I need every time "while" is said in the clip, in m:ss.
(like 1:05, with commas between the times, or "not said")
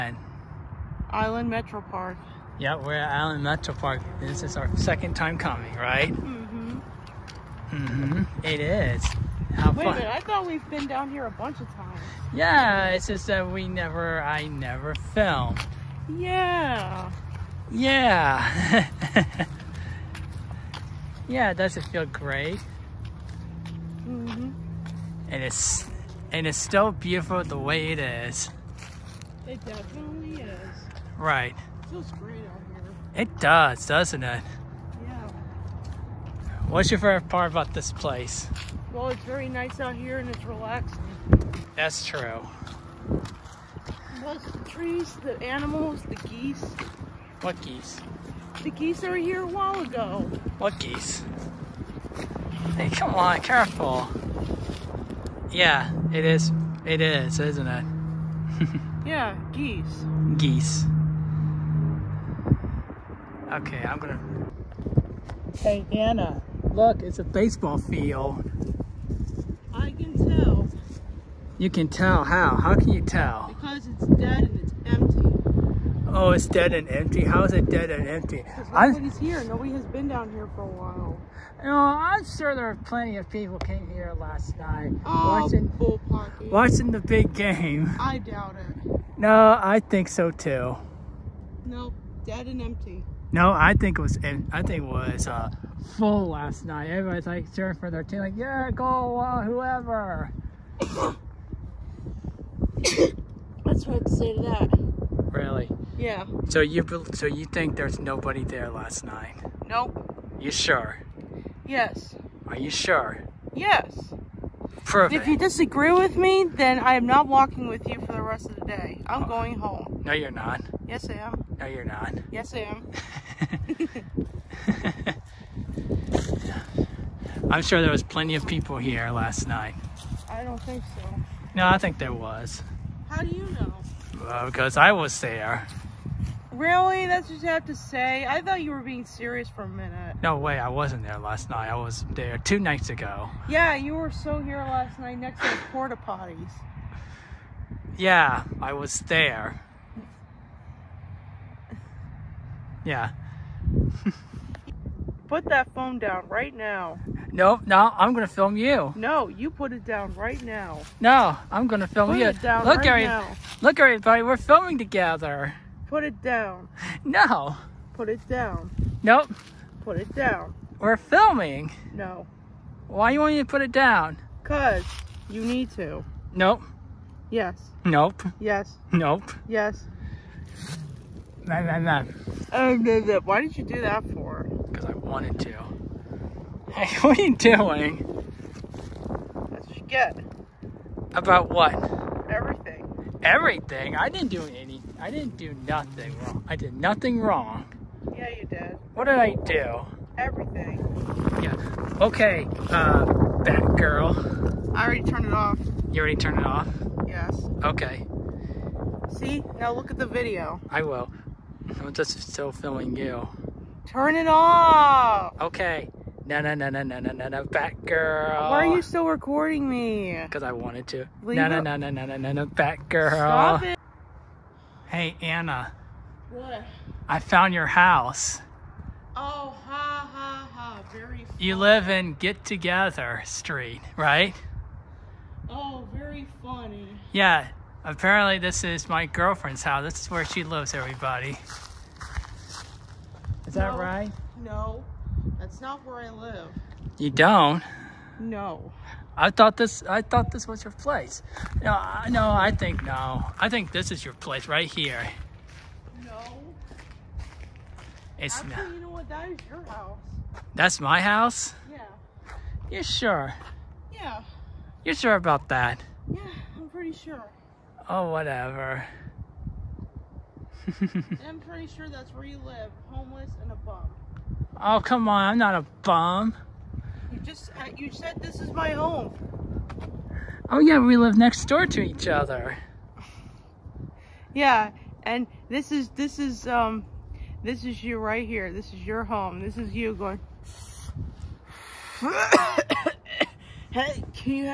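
0:49, 1:20.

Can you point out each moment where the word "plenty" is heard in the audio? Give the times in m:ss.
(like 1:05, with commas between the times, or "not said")
1:22, 2:08.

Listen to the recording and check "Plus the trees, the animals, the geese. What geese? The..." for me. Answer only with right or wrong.
right.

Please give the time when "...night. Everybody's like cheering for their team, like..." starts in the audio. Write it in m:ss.
1:36.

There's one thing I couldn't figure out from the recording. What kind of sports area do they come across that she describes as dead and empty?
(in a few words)
baseball field.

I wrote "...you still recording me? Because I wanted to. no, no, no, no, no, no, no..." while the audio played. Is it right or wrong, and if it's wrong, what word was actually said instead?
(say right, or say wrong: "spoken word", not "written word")
right.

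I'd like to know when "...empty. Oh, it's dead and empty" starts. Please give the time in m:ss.
1:14.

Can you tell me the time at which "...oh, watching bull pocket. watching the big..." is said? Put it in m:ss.
1:25.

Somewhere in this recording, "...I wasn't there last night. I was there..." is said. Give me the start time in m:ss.
2:20.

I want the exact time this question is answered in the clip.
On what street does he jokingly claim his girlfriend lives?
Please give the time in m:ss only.
3:52.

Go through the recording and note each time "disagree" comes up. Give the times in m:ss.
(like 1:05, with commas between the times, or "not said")
1:55.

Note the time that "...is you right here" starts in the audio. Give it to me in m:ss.
4:47.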